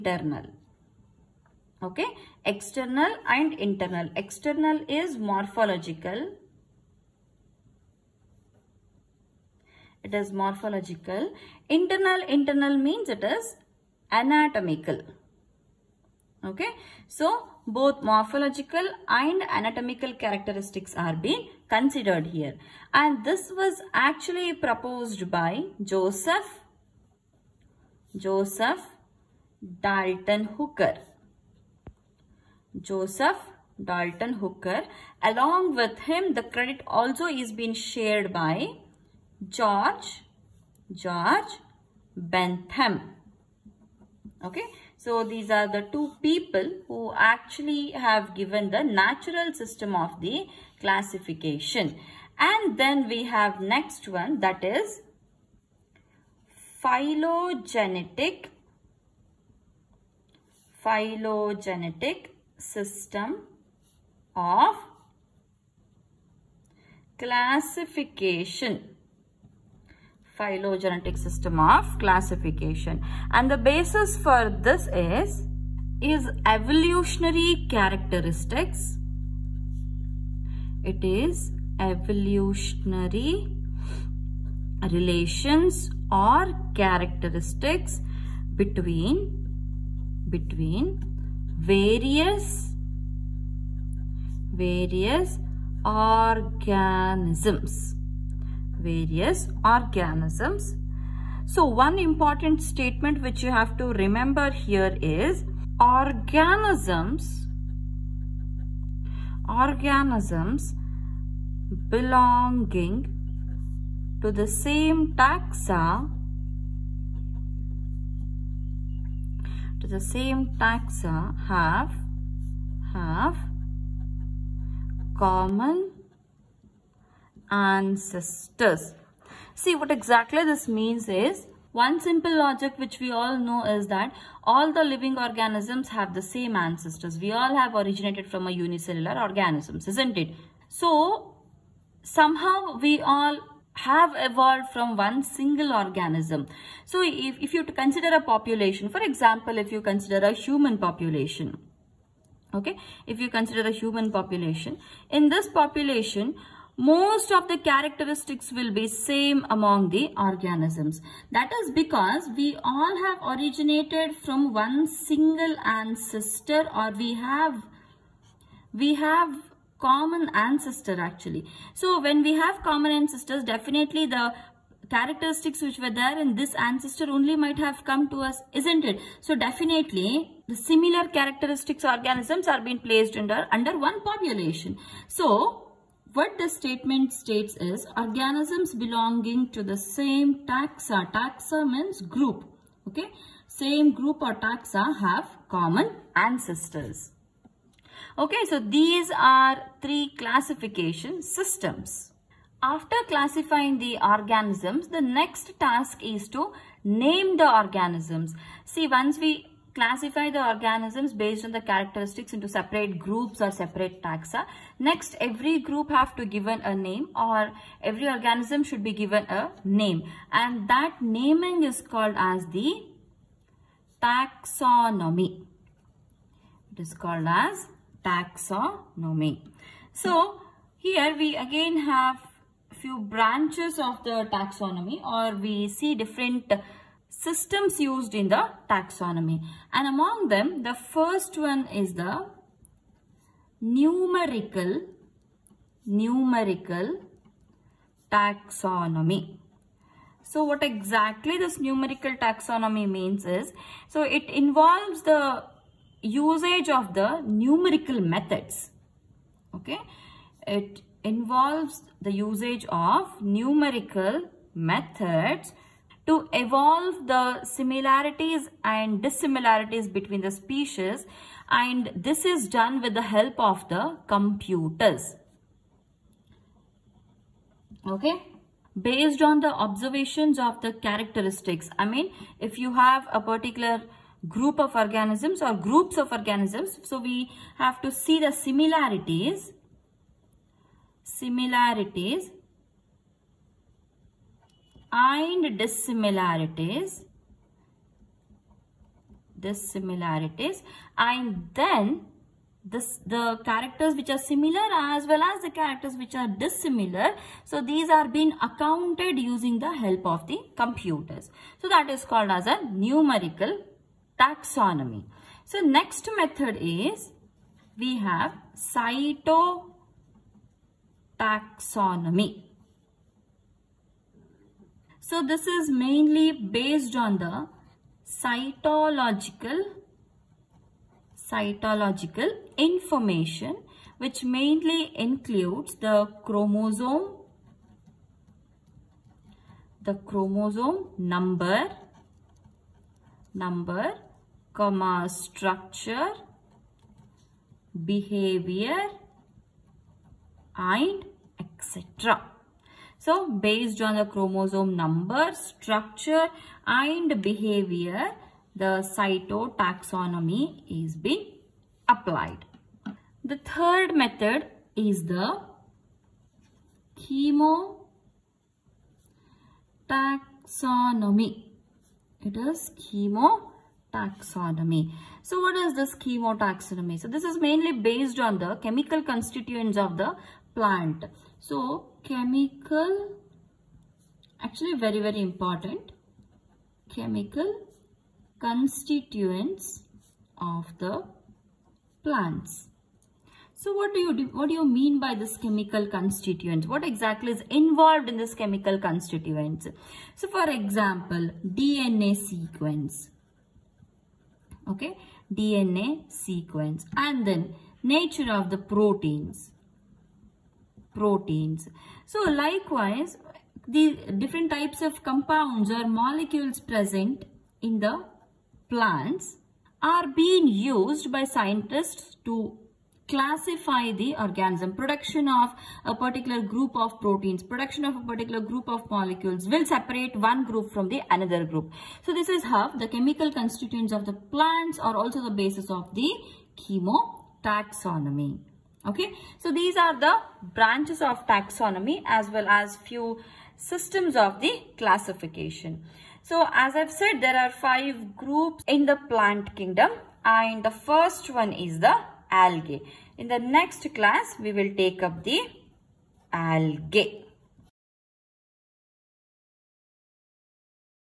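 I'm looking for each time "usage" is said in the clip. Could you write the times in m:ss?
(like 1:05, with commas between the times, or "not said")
4:16, 4:22.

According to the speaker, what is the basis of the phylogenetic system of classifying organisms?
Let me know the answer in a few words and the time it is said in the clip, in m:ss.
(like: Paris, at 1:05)
Evolutionary characteristics, at 1:16.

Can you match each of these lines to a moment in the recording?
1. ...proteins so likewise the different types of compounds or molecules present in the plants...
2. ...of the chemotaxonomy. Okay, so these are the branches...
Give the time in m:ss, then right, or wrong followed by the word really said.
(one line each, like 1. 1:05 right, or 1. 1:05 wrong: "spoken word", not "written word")
1. 6:50 right
2. 7:15 right.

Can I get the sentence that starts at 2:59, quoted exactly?
So definitely the similar characteristics organisms are being placed under, under one population.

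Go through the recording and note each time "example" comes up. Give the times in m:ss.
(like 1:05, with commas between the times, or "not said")
2:29, 6:40.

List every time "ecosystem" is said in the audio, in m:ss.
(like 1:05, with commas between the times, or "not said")
not said.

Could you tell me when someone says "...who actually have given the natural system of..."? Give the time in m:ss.
0:46.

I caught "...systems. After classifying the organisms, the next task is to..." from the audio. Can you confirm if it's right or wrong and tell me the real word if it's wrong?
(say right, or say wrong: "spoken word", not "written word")
right.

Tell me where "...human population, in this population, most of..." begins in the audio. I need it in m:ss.
2:33.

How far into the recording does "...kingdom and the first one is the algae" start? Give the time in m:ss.
7:29.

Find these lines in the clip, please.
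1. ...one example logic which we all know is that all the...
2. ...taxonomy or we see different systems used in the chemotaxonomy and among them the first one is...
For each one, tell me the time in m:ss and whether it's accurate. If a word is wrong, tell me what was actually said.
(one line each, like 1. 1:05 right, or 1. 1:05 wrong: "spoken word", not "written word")
1. 2:11 wrong: "simple", not "example"
2. 3:54 wrong: "taxonomy", not "chemotaxonomy".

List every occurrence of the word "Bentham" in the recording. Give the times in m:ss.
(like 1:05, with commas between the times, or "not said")
0:42.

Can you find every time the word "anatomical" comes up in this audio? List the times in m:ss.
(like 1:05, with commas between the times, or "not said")
0:14, 0:19.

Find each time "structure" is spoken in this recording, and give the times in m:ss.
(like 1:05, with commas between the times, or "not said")
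5:45, 5:55.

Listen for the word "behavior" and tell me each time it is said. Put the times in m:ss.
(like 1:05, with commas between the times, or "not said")
5:47, 5:57.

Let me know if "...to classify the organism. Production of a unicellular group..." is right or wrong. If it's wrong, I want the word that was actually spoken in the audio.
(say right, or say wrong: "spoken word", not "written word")
wrong: "particular", not "unicellular".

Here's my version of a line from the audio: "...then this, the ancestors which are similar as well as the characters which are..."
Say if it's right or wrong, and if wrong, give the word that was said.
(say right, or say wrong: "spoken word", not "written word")
wrong: "characters", not "ancestors".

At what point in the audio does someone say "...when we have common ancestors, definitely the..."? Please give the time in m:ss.
2:51.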